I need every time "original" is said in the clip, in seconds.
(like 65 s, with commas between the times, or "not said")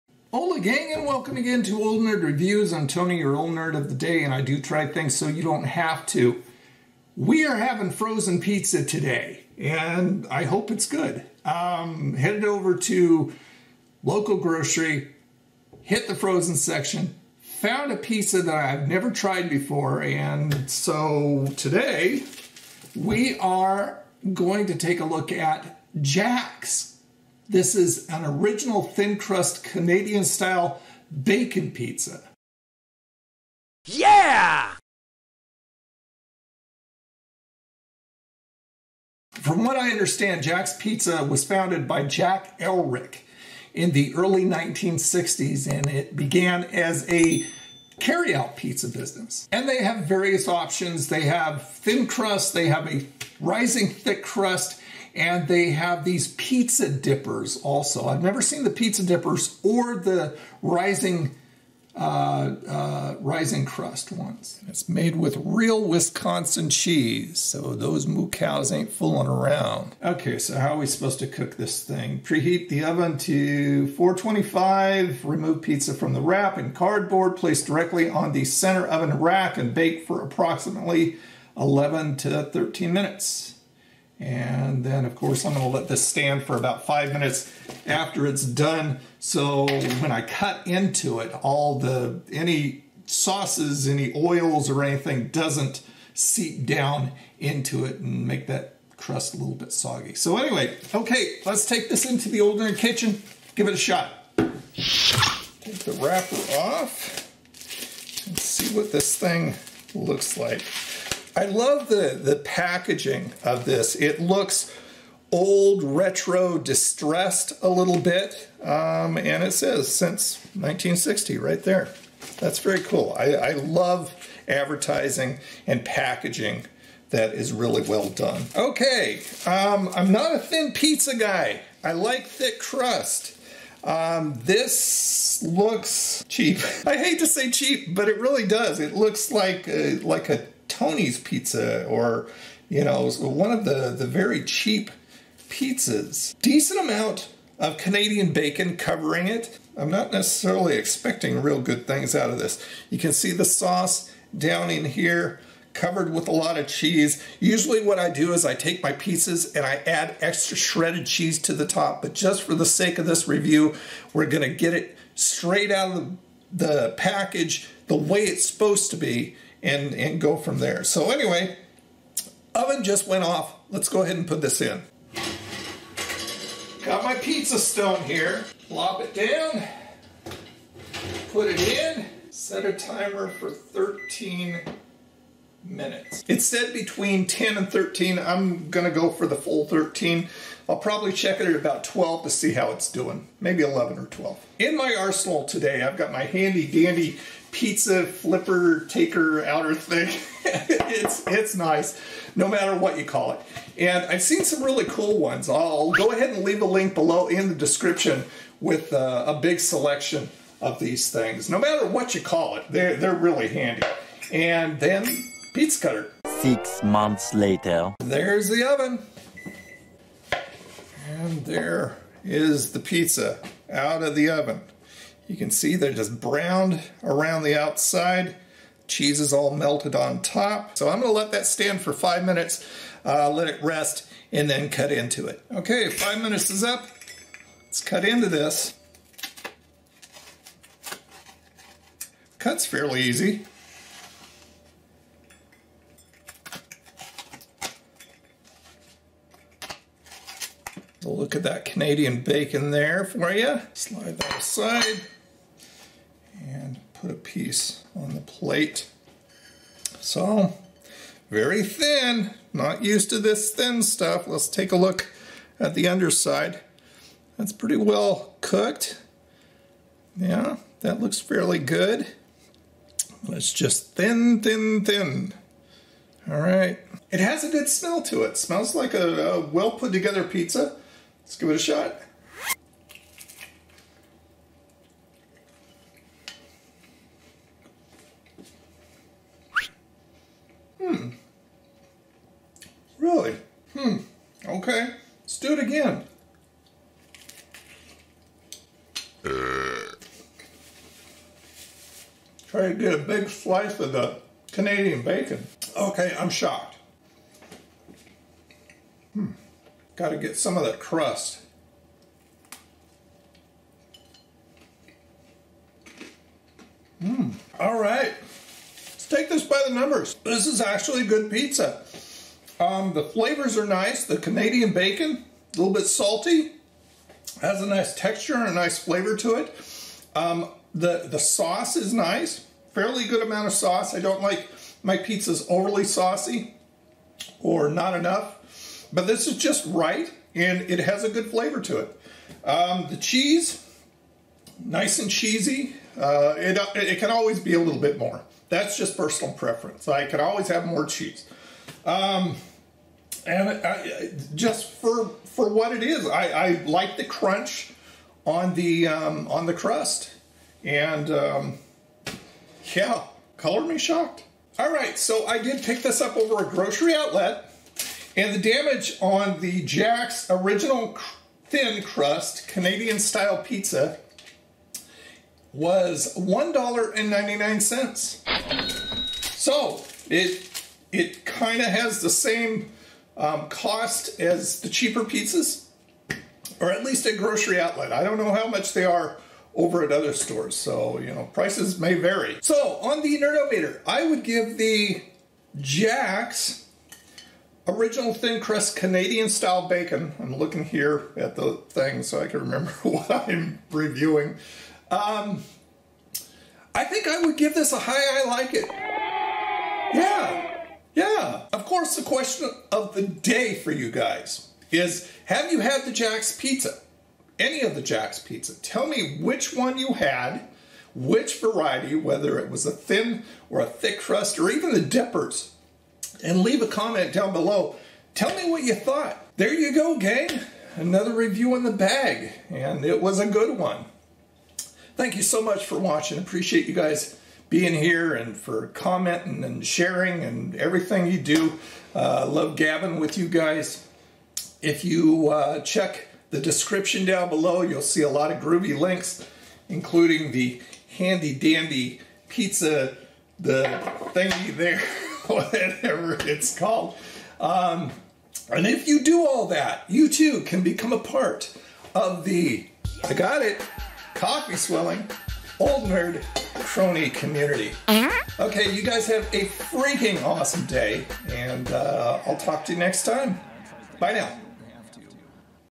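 28 s, 370 s, 397 s.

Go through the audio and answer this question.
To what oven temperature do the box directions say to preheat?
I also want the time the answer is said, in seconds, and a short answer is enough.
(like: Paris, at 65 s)
425, at 73 s.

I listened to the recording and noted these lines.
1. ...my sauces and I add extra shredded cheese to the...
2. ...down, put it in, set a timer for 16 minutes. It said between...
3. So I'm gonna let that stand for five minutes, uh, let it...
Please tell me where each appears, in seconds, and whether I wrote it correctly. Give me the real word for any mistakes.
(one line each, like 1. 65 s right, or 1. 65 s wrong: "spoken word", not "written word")
1. 158 s wrong: "pieces", not "sauces"
2. 179 s wrong: "13", not "16"
3. 230 s right.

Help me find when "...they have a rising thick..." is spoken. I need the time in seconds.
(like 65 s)
52 s.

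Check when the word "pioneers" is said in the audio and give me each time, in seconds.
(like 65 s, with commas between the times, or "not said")
not said.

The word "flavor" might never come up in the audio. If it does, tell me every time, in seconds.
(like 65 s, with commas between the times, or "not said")
323 s, 328 s, 341 s.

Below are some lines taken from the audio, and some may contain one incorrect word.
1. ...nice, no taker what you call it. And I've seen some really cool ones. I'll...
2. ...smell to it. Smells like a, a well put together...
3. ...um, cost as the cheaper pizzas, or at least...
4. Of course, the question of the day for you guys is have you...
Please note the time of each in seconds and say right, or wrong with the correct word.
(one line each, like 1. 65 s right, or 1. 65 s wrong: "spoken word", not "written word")
1. 201 s wrong: "matter", not "taker"
2. 277 s right
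3. 383 s right
4. 411 s right.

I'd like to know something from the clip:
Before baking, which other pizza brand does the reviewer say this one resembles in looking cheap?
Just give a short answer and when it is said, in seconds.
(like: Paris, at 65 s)
Tony's Pizza, at 140 s.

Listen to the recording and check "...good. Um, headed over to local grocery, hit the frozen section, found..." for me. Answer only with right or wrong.
right.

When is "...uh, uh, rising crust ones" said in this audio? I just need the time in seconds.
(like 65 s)
61 s.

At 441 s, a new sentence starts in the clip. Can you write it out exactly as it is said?
Uh, love gabbing with you guys.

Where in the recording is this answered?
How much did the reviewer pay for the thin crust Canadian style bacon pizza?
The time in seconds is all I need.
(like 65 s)
376 s.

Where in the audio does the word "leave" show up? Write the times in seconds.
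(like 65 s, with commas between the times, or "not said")
206 s, 426 s.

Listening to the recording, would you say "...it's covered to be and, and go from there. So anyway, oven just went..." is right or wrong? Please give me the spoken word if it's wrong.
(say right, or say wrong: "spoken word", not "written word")
wrong: "supposed", not "covered".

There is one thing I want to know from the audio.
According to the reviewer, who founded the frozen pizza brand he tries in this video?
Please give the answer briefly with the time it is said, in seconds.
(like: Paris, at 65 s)
Jack Elrick, at 42 s.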